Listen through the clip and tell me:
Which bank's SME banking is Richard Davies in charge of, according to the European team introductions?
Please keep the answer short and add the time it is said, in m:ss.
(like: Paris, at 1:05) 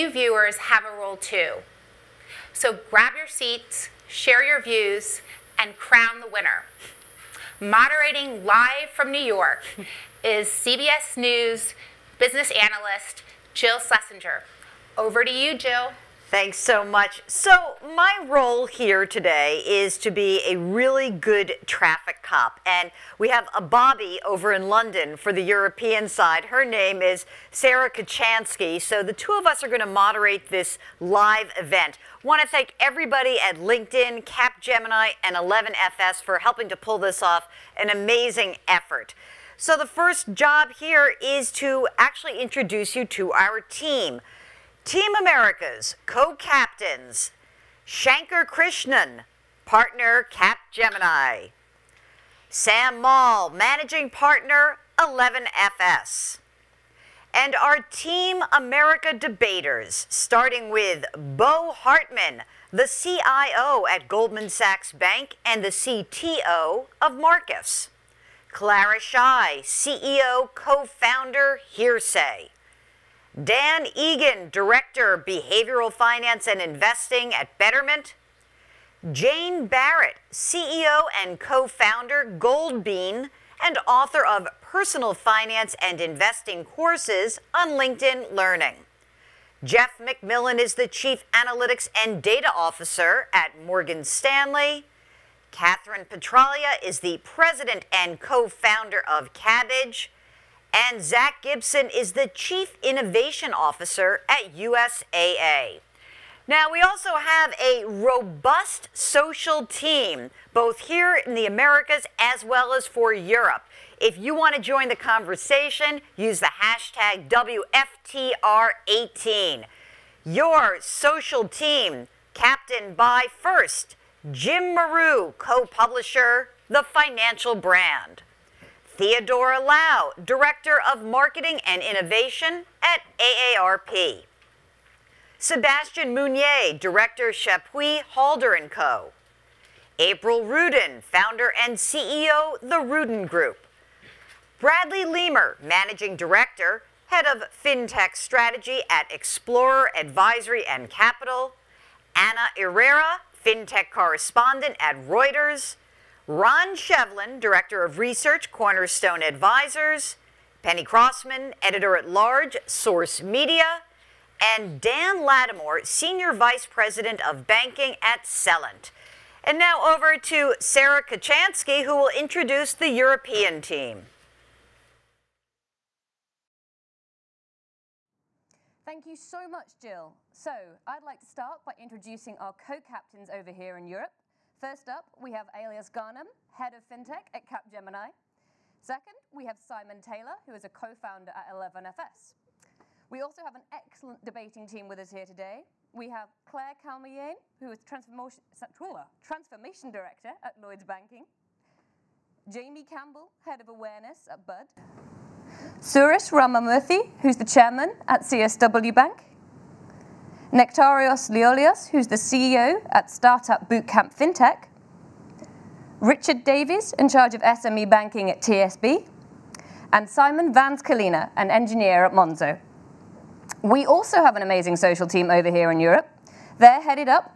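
TSB, at 3:38.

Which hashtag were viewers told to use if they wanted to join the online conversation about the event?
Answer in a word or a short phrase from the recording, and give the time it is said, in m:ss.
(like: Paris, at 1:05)
WFTR18, at 1:57.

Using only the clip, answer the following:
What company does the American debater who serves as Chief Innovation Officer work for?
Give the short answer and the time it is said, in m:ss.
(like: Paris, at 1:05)
USAA, at 1:44.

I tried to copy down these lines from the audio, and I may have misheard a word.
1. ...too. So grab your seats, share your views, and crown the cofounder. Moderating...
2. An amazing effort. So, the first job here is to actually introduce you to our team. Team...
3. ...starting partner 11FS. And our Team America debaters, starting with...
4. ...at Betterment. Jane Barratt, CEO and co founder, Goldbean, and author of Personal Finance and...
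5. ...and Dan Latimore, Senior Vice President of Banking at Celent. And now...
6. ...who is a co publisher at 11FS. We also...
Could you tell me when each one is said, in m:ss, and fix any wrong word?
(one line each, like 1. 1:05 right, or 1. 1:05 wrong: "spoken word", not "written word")
1. 0:01 wrong: "winner", not "cofounder"
2. 0:37 right
3. 0:53 wrong: "managing", not "starting"
4. 1:17 right
5. 2:44 right
6. 3:10 wrong: "founder", not "publisher".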